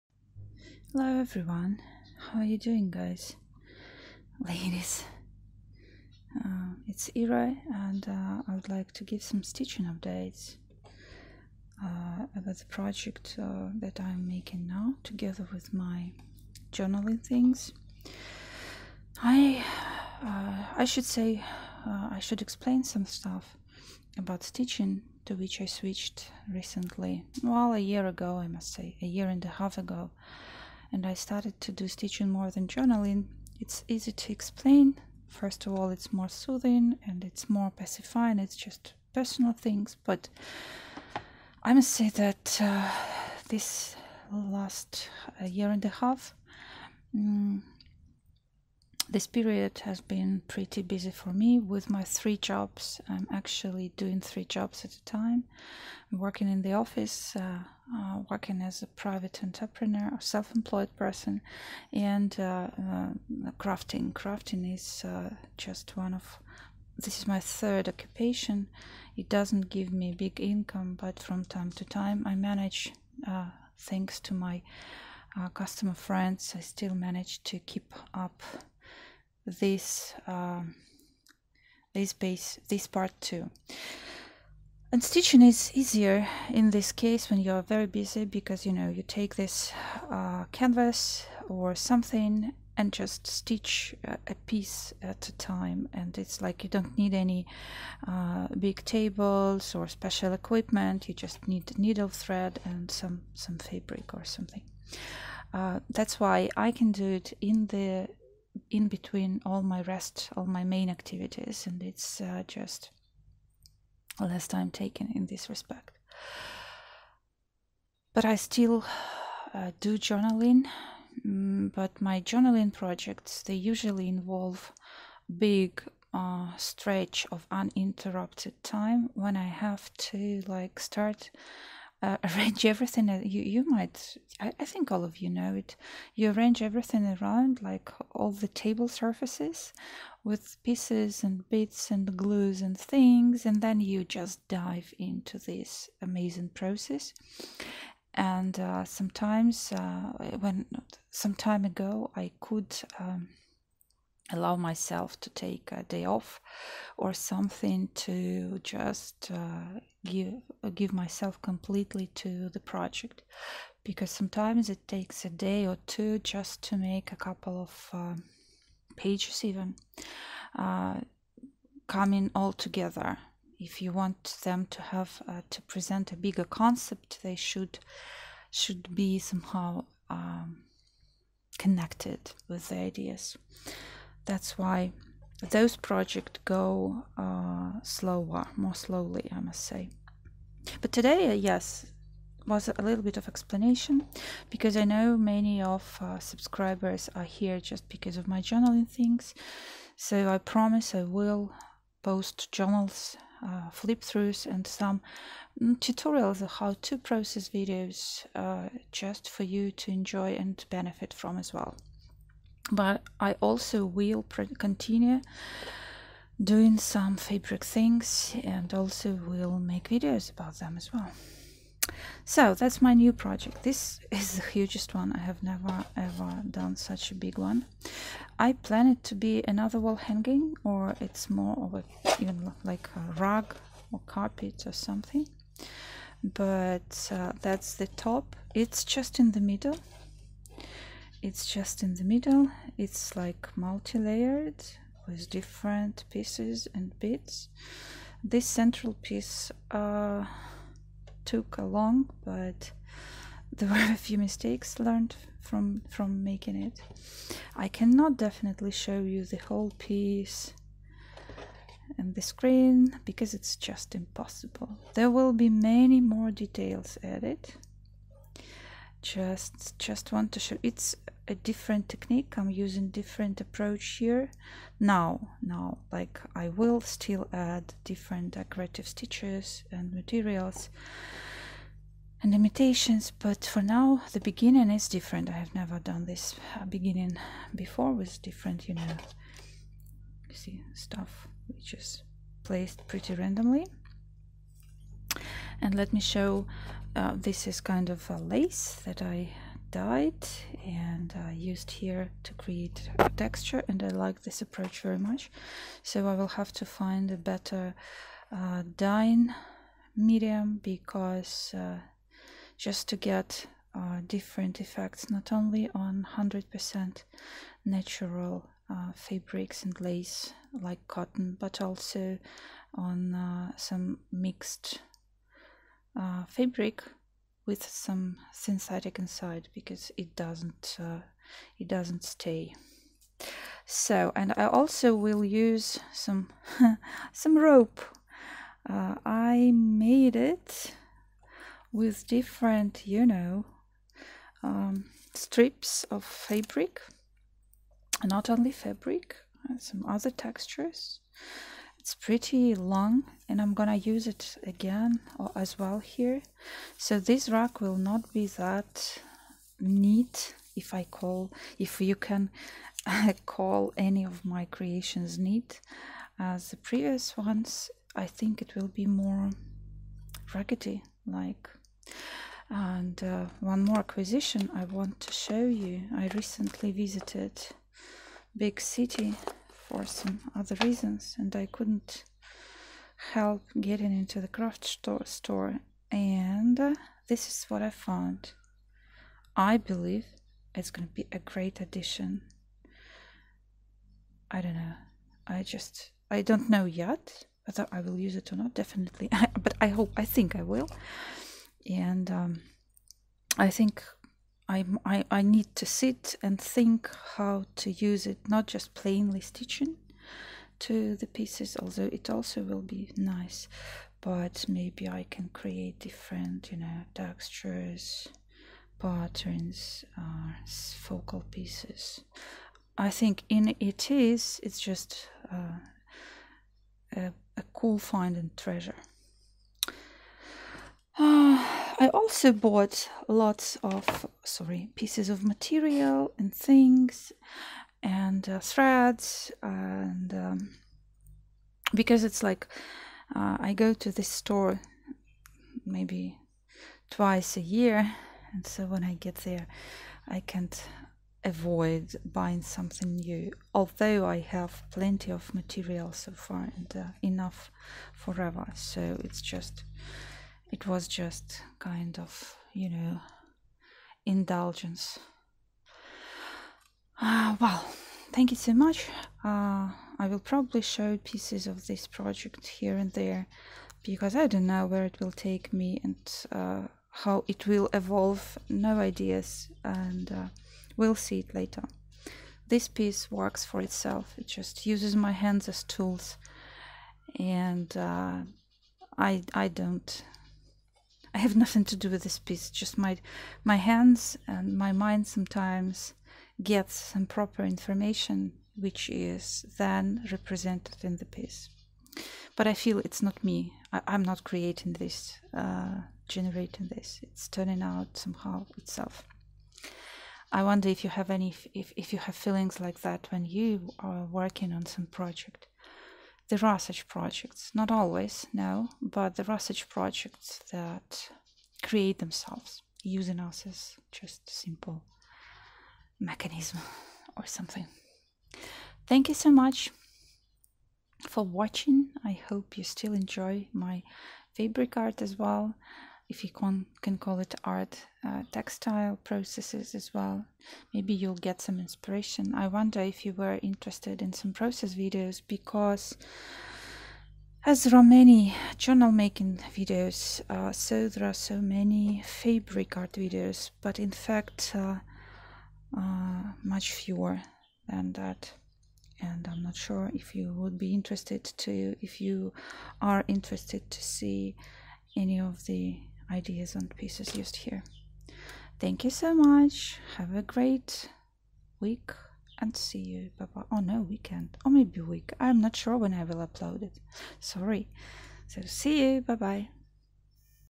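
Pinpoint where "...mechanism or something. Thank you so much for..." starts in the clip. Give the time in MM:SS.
08:45.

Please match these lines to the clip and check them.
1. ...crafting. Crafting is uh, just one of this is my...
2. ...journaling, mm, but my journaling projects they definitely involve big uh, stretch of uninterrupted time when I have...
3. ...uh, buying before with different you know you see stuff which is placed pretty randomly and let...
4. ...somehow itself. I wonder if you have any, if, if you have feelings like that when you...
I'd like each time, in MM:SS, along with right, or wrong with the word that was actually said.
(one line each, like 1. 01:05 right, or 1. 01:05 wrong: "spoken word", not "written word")
1. 01:03 right
2. 01:59 wrong: "usually", not "definitely"
3. 04:46 wrong: "beginning", not "buying"
4. 08:27 right.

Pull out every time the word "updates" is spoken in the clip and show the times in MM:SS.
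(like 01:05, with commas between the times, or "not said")
00:09.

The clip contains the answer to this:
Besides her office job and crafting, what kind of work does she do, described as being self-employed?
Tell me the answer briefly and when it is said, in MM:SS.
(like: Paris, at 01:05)
private entrepreneur, at 00:58.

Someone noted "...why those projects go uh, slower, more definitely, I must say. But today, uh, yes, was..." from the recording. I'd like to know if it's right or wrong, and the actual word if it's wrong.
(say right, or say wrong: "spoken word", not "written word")
wrong: "slowly", not "definitely".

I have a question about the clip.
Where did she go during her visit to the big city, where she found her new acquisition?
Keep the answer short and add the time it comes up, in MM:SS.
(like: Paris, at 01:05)
craft store, at 06:24.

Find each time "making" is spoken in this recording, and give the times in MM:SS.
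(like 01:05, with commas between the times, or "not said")
00:14, 04:16, 09:08.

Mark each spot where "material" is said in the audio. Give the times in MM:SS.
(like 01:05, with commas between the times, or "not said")
04:39, 07:15, 07:35.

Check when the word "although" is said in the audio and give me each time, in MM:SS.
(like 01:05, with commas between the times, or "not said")
06:51, 07:33.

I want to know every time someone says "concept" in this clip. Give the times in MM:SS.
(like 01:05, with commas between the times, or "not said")
02:56.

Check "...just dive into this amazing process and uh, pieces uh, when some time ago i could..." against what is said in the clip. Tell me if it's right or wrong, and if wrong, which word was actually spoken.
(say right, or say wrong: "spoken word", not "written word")
wrong: "sometimes", not "pieces".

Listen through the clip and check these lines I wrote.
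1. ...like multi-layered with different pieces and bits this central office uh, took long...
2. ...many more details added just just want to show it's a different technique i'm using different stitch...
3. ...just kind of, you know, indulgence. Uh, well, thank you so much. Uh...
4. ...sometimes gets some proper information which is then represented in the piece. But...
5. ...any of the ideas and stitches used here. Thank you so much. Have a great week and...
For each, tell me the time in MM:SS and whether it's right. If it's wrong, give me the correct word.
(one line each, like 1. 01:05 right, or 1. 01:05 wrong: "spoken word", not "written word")
1. 04:03 wrong: "piece", not "office"
2. 04:25 wrong: "approach", not "stitch"
3. 07:40 right
4. 08:15 right
5. 09:24 wrong: "pieces", not "stitches".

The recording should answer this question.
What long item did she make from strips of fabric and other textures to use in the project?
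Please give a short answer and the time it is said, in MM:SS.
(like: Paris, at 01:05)
rope, at 05:37.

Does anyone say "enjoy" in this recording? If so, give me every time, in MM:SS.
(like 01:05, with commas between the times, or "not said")
03:29, 08:52.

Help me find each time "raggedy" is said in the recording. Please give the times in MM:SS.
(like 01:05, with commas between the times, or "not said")
06:10.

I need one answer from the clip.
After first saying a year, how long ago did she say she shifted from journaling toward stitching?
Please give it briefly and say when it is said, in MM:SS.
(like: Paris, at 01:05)
a year and a half, at 00:29.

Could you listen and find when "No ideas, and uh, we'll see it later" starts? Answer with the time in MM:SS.
07:58.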